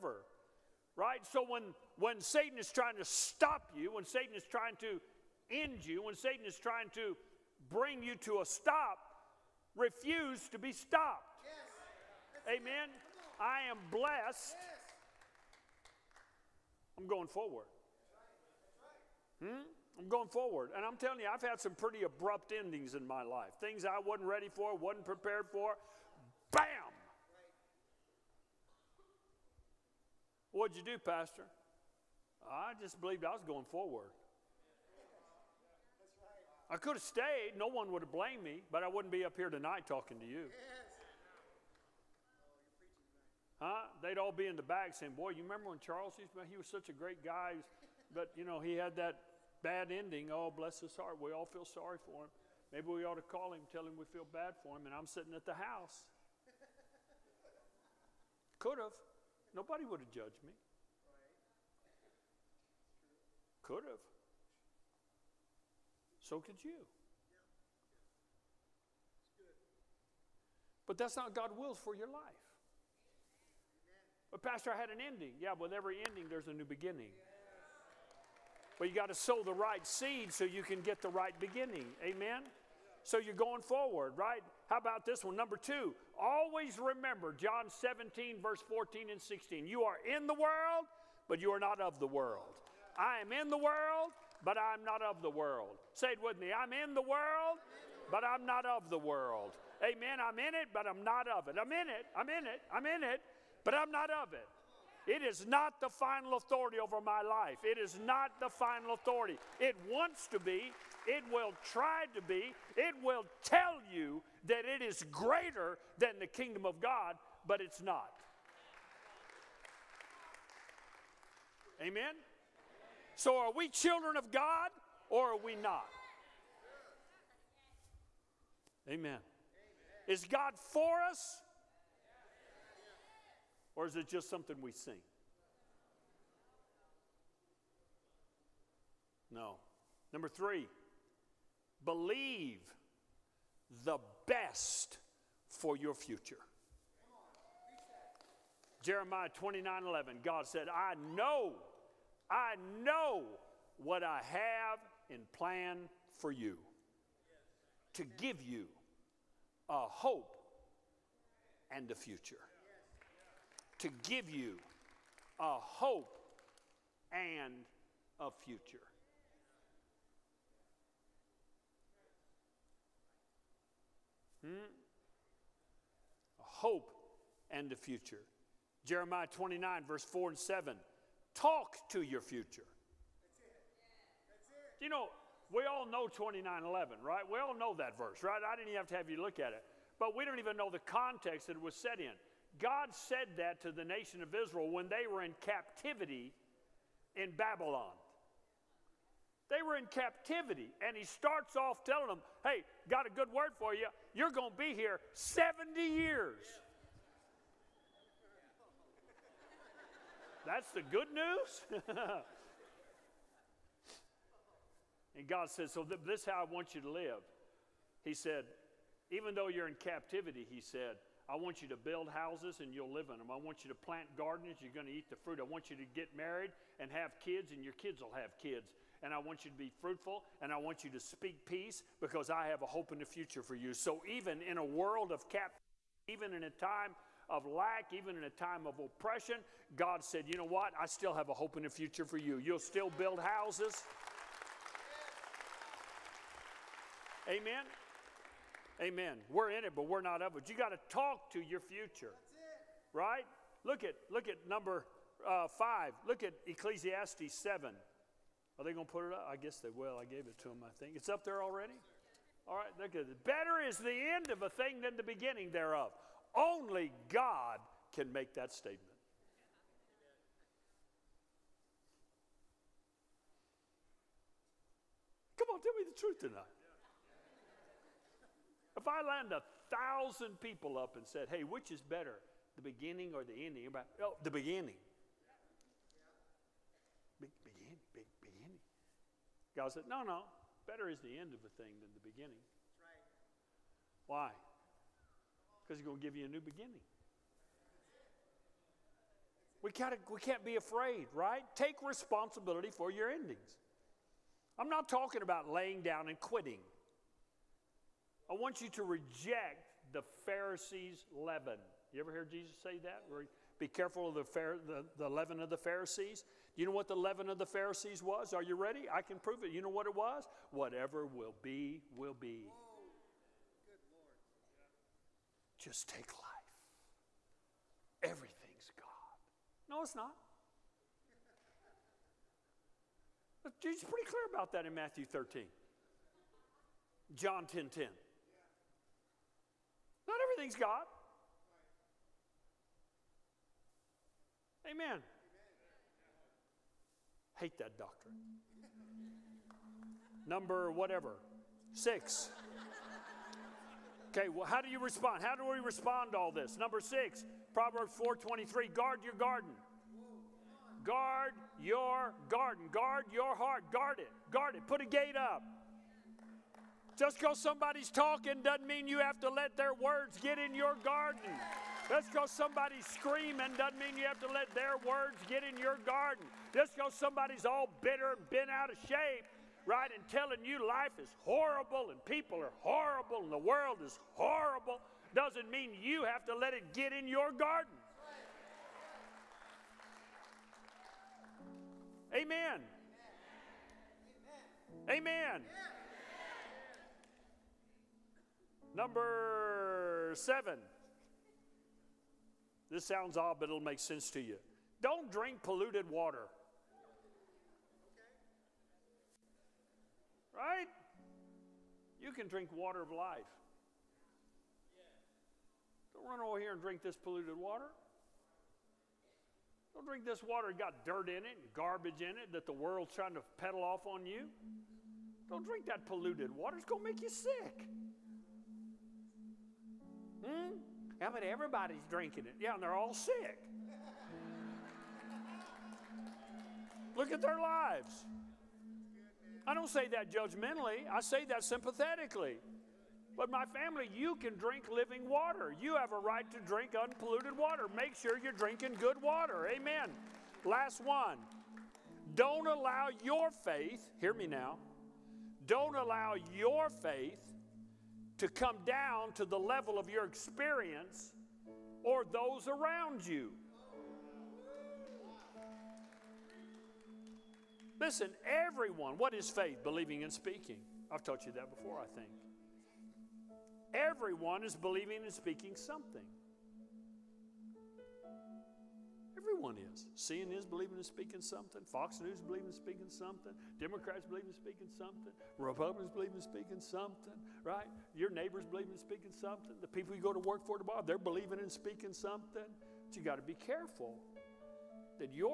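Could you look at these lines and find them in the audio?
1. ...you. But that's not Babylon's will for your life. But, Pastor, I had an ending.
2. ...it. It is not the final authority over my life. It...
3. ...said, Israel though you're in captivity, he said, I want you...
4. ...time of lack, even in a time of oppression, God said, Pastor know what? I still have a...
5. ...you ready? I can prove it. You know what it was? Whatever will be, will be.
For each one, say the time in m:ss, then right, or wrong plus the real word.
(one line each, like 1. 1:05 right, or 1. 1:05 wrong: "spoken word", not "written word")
1. 1:06 wrong: "God", not "Babylon"
2. 1:44 right
3. 3:38 wrong: "Even", not "Israel"
4. 3:56 wrong: "You", not "Pastor"
5. 5:18 right.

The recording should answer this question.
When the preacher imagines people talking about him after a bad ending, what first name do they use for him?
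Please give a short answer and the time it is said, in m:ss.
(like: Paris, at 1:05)
Charles, at 0:45.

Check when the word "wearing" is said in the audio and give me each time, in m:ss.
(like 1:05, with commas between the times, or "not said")
not said.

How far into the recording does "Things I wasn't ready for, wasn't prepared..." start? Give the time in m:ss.
0:23.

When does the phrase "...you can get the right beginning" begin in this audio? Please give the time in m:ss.
1:20.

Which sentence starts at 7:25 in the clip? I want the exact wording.
You have a right to drink unpolluted water.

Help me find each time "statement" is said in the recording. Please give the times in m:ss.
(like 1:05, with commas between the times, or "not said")
4:28.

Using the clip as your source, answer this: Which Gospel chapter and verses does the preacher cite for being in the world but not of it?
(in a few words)
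John 17:14 and 16.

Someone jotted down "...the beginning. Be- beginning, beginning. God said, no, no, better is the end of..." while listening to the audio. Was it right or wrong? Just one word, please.
right.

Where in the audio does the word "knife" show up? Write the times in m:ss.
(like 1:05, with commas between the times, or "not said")
not said.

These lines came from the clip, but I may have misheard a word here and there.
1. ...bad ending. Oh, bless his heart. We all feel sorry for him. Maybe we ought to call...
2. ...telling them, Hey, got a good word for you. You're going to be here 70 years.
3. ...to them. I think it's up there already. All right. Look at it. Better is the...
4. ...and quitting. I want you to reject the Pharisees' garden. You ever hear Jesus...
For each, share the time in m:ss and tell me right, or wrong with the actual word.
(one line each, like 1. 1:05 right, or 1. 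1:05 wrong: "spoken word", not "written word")
1. 0:49 right
2. 3:21 right
3. 4:20 right
4. 5:06 wrong: "leaven", not "garden".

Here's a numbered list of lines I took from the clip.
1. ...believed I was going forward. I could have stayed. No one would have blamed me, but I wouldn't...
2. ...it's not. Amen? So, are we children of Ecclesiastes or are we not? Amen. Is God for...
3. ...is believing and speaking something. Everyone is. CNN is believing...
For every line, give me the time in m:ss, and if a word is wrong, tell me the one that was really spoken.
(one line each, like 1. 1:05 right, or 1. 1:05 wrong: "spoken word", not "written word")
1. 0:33 right
2. 1:57 wrong: "God", not "Ecclesiastes"
3. 7:54 right.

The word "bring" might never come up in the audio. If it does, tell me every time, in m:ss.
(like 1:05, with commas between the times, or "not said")
0:07.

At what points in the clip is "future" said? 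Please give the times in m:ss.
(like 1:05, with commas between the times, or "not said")
2:25, 2:41, 2:48, 2:57, 3:02, 3:53, 4:01, 4:11.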